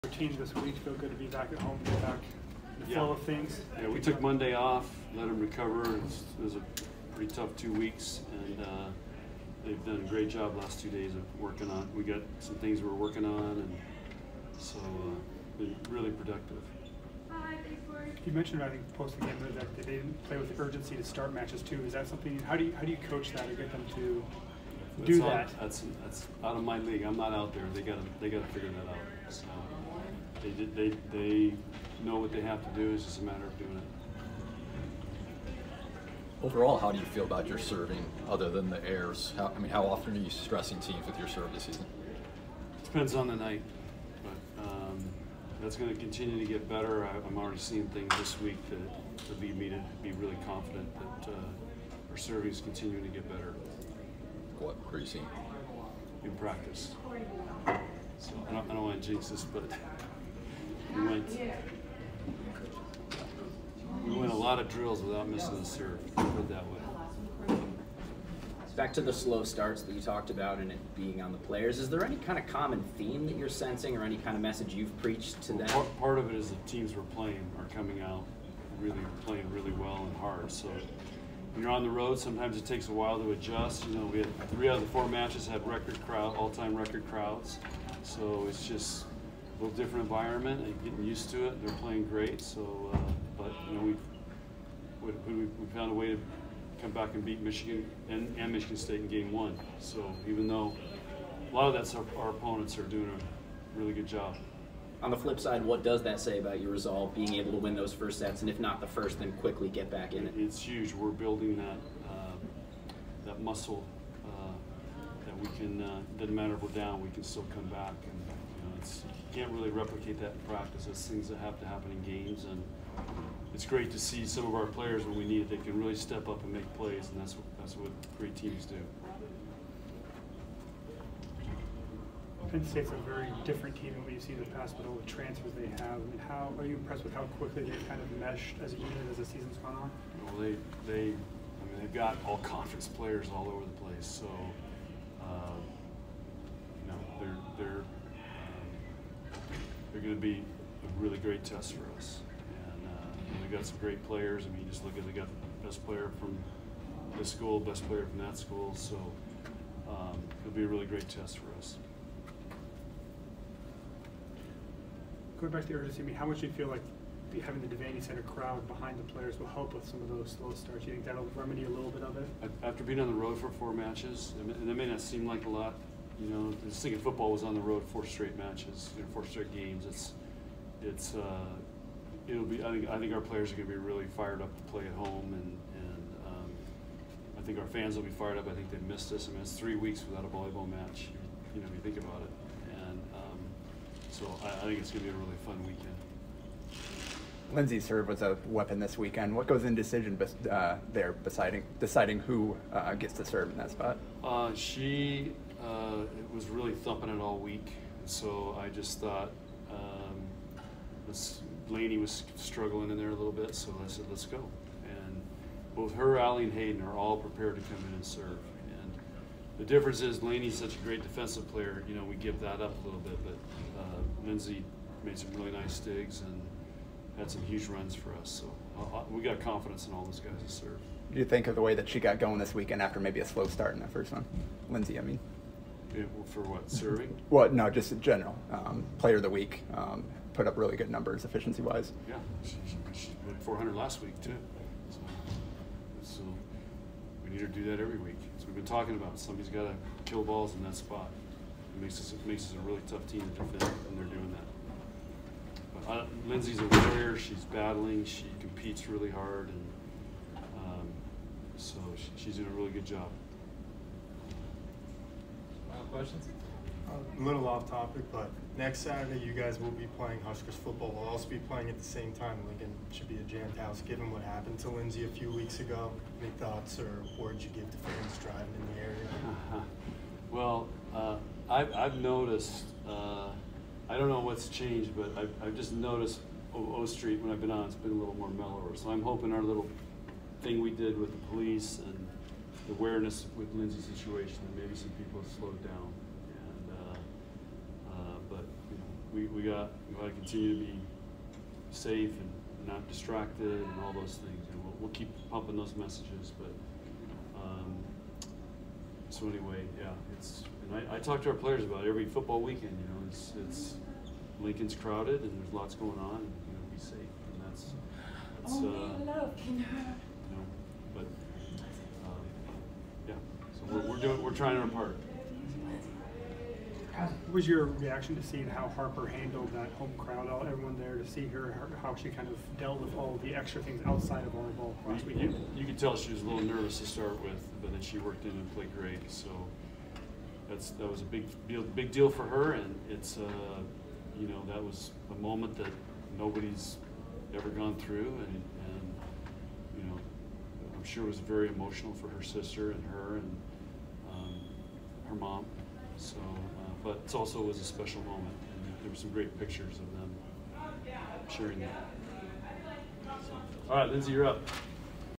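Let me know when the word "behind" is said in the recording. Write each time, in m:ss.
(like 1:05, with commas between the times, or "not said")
2:48.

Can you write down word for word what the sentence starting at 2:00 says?
It's things that have to happen in games, and it's great to see some of our players when we need it.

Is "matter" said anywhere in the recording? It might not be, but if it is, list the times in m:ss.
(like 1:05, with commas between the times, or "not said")
0:33, 1:56.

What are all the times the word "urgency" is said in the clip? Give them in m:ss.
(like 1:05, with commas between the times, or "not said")
0:20, 2:45.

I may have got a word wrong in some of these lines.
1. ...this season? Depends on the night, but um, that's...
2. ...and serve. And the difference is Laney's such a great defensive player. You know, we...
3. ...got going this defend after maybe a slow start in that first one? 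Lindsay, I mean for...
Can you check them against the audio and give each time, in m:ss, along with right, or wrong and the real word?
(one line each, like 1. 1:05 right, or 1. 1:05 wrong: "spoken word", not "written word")
1. 0:41 right
2. 3:37 right
3. 3:52 wrong: "weekend", not "defend".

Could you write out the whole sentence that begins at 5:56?
but it also was a special moment.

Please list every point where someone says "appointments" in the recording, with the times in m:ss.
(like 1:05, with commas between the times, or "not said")
not said.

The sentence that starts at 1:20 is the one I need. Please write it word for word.
So when you're on the road, sometimes it takes a while to adjust.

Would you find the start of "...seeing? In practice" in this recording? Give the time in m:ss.
0:55.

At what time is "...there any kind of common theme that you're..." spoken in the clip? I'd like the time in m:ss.
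1:11.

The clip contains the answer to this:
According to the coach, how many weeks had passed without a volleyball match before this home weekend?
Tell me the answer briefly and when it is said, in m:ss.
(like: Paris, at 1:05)
3, at 3:09.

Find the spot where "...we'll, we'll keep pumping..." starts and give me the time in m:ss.
5:04.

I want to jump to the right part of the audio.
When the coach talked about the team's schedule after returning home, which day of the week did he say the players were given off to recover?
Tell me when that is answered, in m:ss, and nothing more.
0:04.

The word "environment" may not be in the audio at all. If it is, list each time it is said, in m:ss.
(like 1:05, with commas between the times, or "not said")
1:30.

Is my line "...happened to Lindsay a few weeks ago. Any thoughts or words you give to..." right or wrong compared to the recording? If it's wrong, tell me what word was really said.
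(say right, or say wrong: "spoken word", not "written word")
right.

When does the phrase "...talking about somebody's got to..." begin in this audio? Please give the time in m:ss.
4:08.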